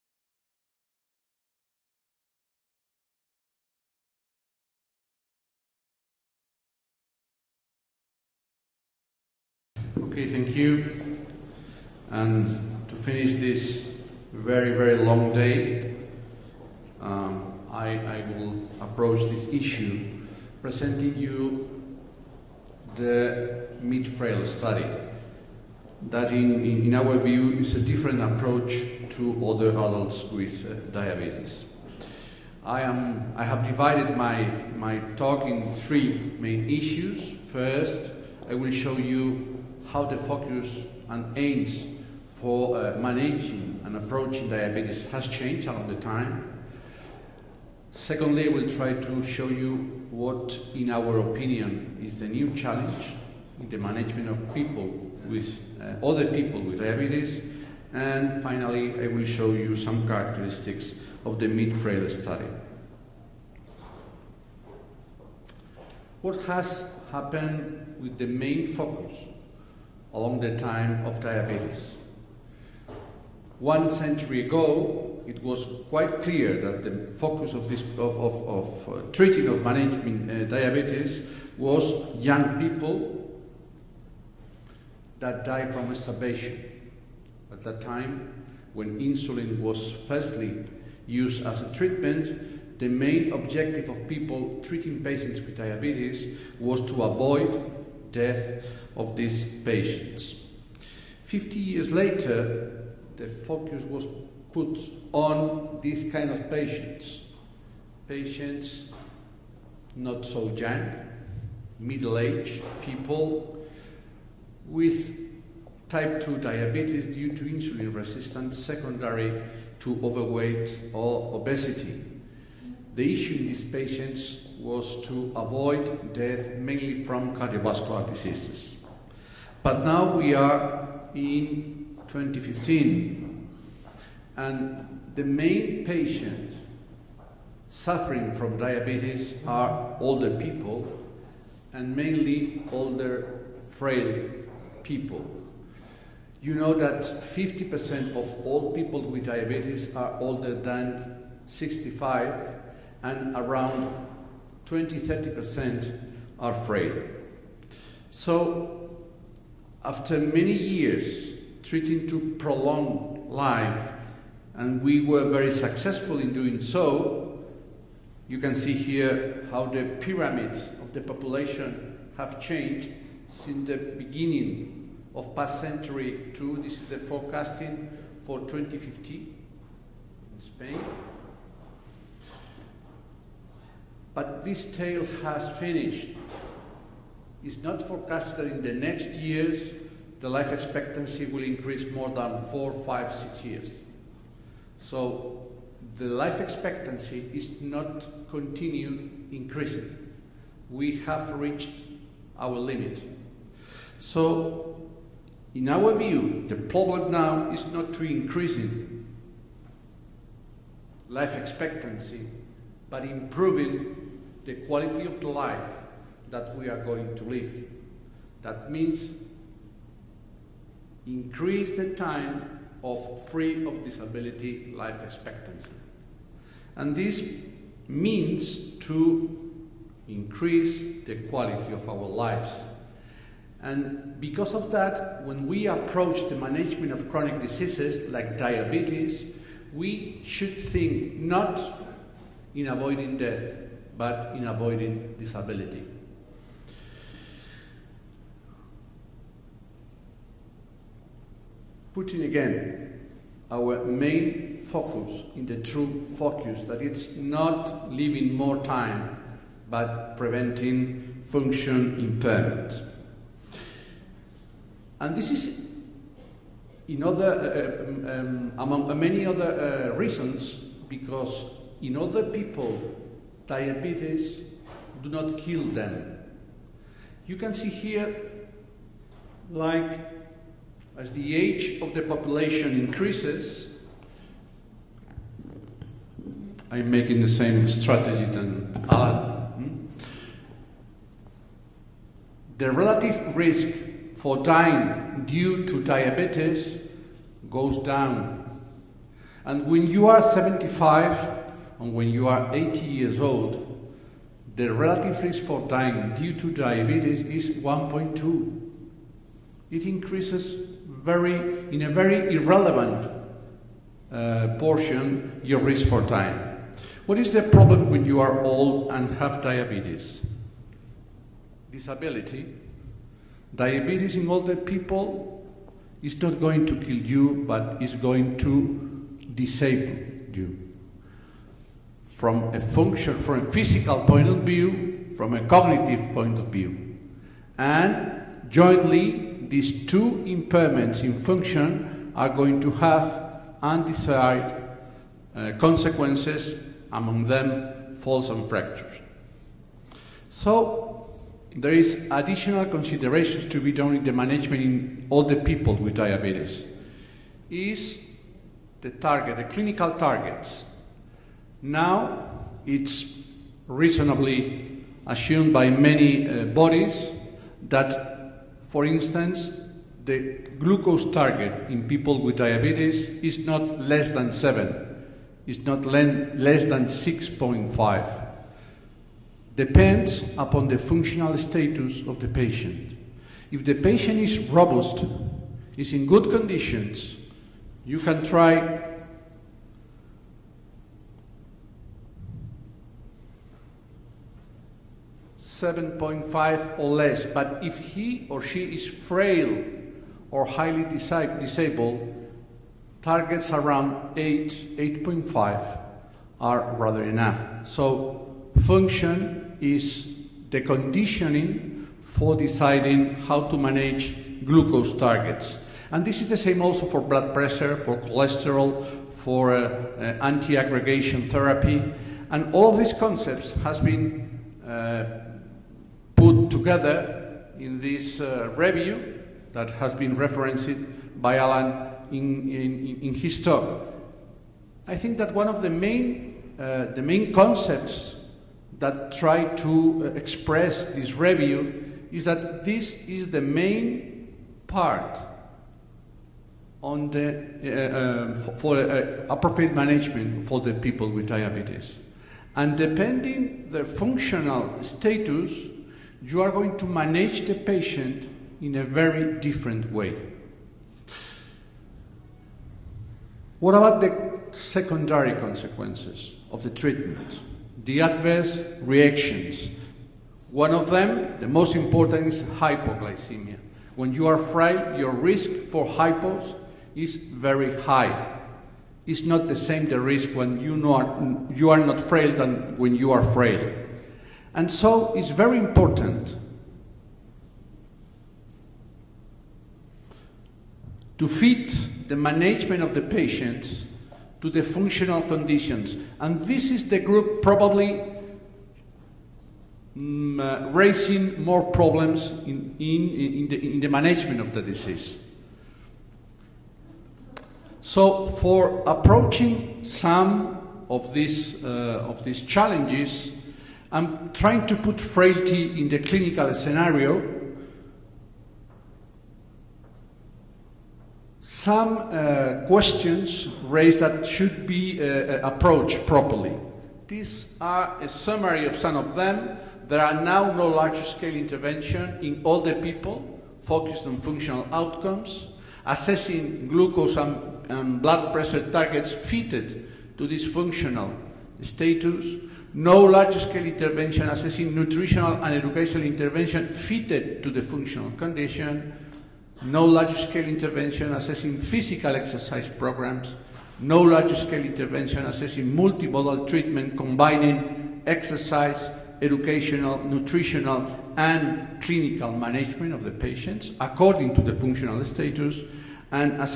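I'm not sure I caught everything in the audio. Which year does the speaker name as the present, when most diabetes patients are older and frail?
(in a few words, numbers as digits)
2015.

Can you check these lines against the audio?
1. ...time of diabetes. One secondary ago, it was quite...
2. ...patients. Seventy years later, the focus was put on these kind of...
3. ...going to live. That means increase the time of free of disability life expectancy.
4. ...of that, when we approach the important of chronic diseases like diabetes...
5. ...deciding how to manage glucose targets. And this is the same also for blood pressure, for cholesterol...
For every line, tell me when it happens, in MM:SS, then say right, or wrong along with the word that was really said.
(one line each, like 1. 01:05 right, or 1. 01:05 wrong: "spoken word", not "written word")
1. 01:10 wrong: "century", not "secondary"
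2. 01:39 wrong: "Fifty", not "Seventy"
3. 03:36 right
4. 03:54 wrong: "management", not "important"
5. 06:52 right.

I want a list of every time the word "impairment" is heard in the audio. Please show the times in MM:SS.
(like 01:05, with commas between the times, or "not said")
04:21, 05:40.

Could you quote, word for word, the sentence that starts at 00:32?
I, am, I have divided my, my talk in three main issues.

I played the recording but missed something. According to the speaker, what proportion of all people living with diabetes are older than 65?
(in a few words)
50%.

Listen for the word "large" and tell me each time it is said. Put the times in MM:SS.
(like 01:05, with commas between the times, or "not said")
08:50, 09:03, 09:09, 09:14.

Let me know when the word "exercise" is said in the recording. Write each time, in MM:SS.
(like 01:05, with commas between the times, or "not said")
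09:12, 09:18.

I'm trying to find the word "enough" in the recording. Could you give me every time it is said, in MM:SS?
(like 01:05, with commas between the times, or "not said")
06:47.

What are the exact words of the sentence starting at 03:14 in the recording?
So the life expectancy is not continue increasing.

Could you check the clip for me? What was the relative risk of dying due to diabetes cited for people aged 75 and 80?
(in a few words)
1.2.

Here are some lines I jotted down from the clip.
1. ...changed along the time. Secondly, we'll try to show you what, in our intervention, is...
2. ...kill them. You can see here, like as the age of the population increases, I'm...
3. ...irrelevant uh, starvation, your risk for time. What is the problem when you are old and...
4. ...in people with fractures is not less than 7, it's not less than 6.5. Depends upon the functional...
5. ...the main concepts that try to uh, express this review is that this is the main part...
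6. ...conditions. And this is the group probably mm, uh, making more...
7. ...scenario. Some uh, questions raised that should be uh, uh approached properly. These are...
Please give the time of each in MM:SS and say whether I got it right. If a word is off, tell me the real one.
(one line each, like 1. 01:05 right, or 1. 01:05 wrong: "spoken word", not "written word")
1. 00:45 wrong: "opinion", not "intervention"
2. 04:35 right
3. 05:12 wrong: "portion", not "starvation"
4. 06:11 wrong: "diabetes", not "fractures"
5. 07:16 right
6. 08:15 wrong: "raising", not "making"
7. 08:36 right.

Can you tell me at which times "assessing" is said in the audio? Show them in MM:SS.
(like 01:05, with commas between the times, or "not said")
08:55, 09:04, 09:11, 09:15.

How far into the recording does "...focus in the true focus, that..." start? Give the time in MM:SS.
04:14.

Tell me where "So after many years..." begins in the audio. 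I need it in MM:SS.
02:38.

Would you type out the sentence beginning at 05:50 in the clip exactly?
So there is additional considerations to be done in the management in the people with diabetes.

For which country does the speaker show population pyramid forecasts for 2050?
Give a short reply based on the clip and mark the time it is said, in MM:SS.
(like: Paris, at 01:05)
Spain, at 03:00.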